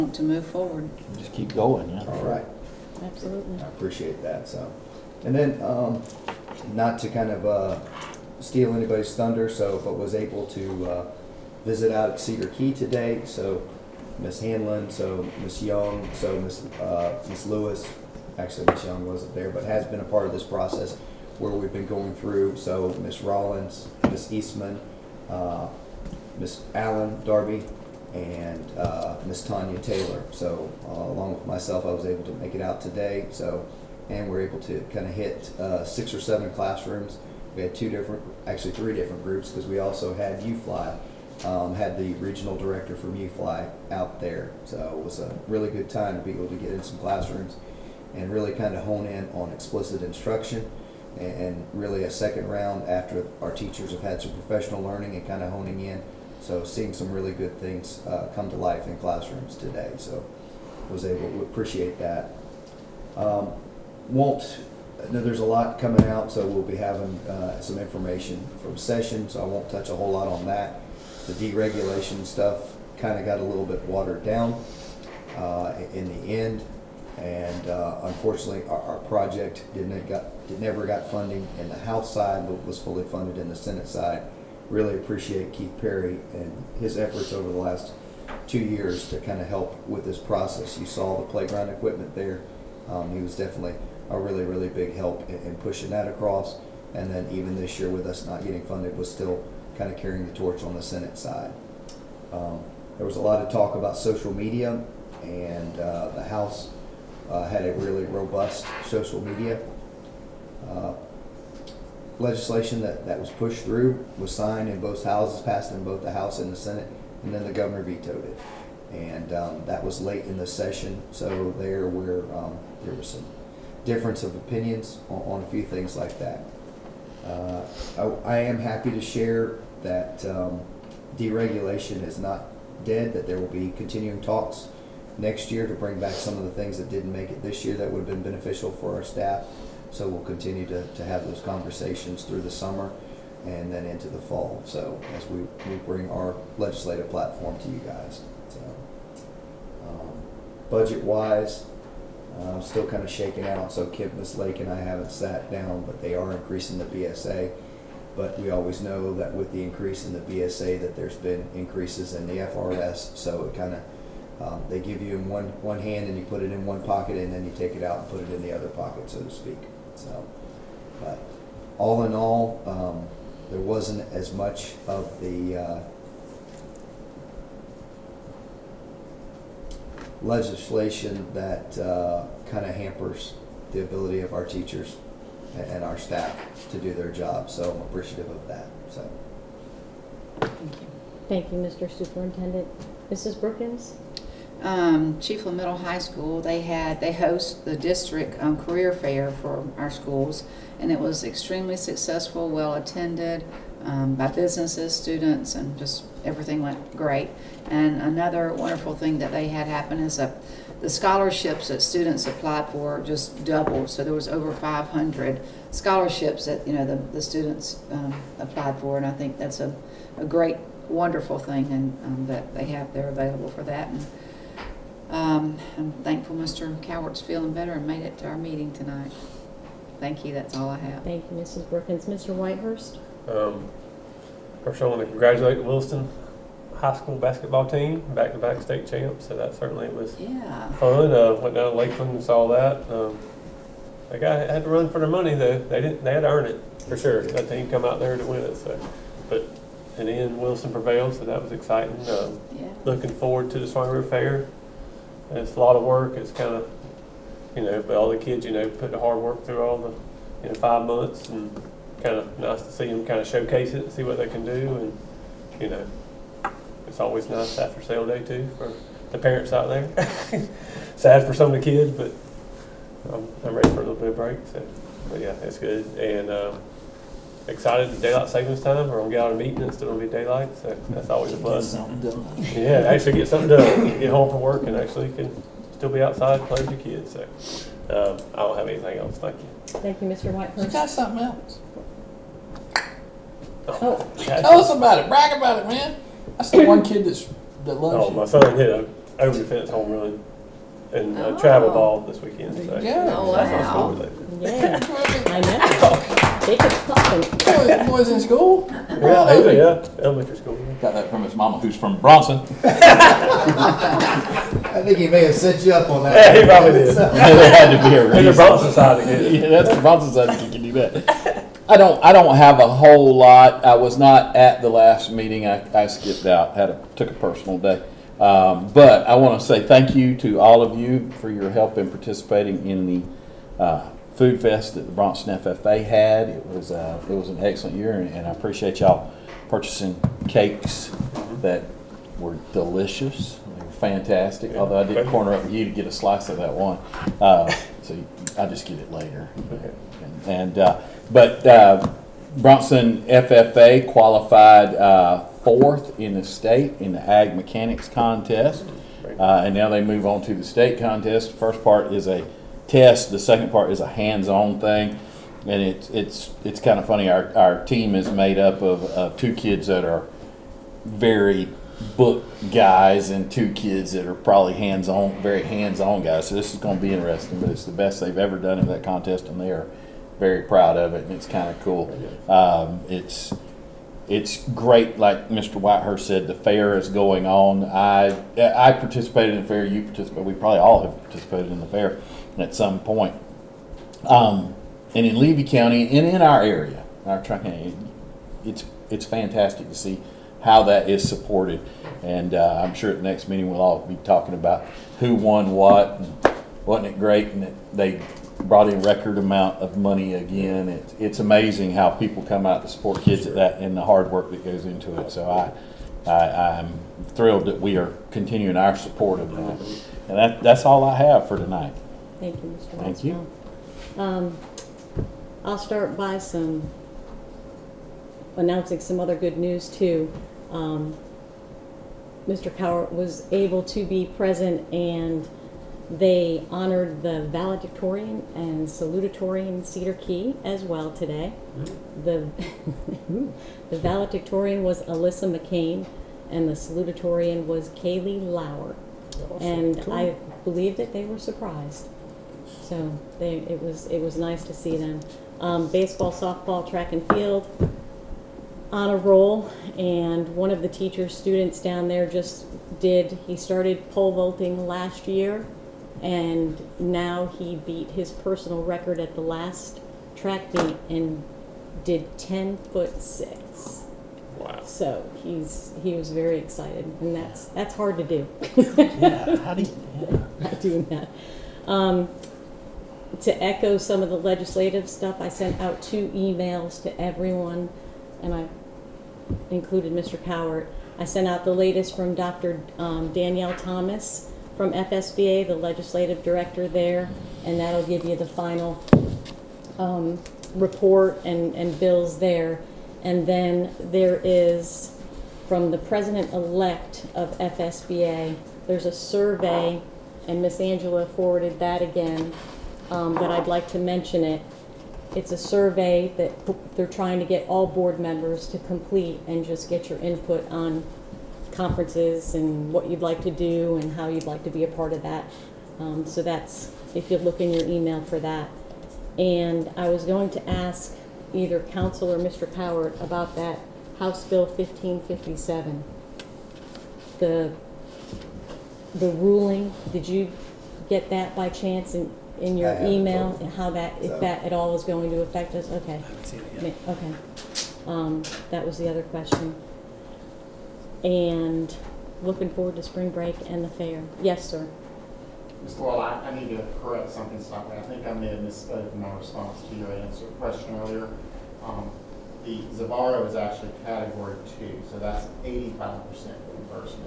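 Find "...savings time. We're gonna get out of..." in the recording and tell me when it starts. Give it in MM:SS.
04:38.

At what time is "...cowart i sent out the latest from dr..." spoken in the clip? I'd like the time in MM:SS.
08:10.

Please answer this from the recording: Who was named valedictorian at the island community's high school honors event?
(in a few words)
Alyssa McCain.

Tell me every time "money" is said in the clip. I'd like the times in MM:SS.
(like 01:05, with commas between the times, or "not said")
04:05, 06:49.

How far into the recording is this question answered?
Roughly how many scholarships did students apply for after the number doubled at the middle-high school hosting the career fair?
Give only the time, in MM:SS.
03:34.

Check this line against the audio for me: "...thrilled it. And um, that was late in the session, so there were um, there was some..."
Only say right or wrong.
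wrong.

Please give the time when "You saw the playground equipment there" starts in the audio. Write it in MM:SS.
01:30.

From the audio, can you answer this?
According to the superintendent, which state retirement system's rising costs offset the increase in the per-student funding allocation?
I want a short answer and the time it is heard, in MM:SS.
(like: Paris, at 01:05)
FRS, at 02:42.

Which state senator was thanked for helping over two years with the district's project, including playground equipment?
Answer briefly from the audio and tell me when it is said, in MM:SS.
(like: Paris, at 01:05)
Keith Perry, at 01:25.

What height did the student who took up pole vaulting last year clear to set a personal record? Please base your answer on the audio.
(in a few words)
10 foot 6.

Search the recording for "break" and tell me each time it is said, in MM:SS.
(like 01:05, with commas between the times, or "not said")
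04:34, 09:13.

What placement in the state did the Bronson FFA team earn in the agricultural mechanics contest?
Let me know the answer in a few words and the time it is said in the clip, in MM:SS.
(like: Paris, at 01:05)
fourth, at 05:55.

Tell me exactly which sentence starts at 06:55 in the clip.
So I, I am thrilled that we are continuing our support of that.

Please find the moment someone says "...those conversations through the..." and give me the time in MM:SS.
02:21.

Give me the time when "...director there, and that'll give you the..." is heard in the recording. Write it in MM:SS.
08:16.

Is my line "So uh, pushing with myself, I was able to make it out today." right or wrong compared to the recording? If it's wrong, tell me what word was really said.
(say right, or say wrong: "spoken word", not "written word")
wrong: "along", not "pushing".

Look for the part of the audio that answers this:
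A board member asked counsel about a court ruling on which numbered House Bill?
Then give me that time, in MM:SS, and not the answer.
08:54.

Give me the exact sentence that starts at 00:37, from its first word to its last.
We had two different, actually three different groups because we also had UFLI.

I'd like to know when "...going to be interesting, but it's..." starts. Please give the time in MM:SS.
06:16.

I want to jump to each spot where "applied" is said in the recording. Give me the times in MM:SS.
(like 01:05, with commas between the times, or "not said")
03:32, 03:38.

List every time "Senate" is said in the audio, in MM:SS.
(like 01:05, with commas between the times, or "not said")
01:23, 01:40, 01:56.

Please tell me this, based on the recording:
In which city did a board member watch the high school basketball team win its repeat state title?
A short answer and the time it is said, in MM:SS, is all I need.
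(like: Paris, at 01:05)
Lakeland, at 04:01.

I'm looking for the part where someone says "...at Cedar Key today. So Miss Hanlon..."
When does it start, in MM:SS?
00:12.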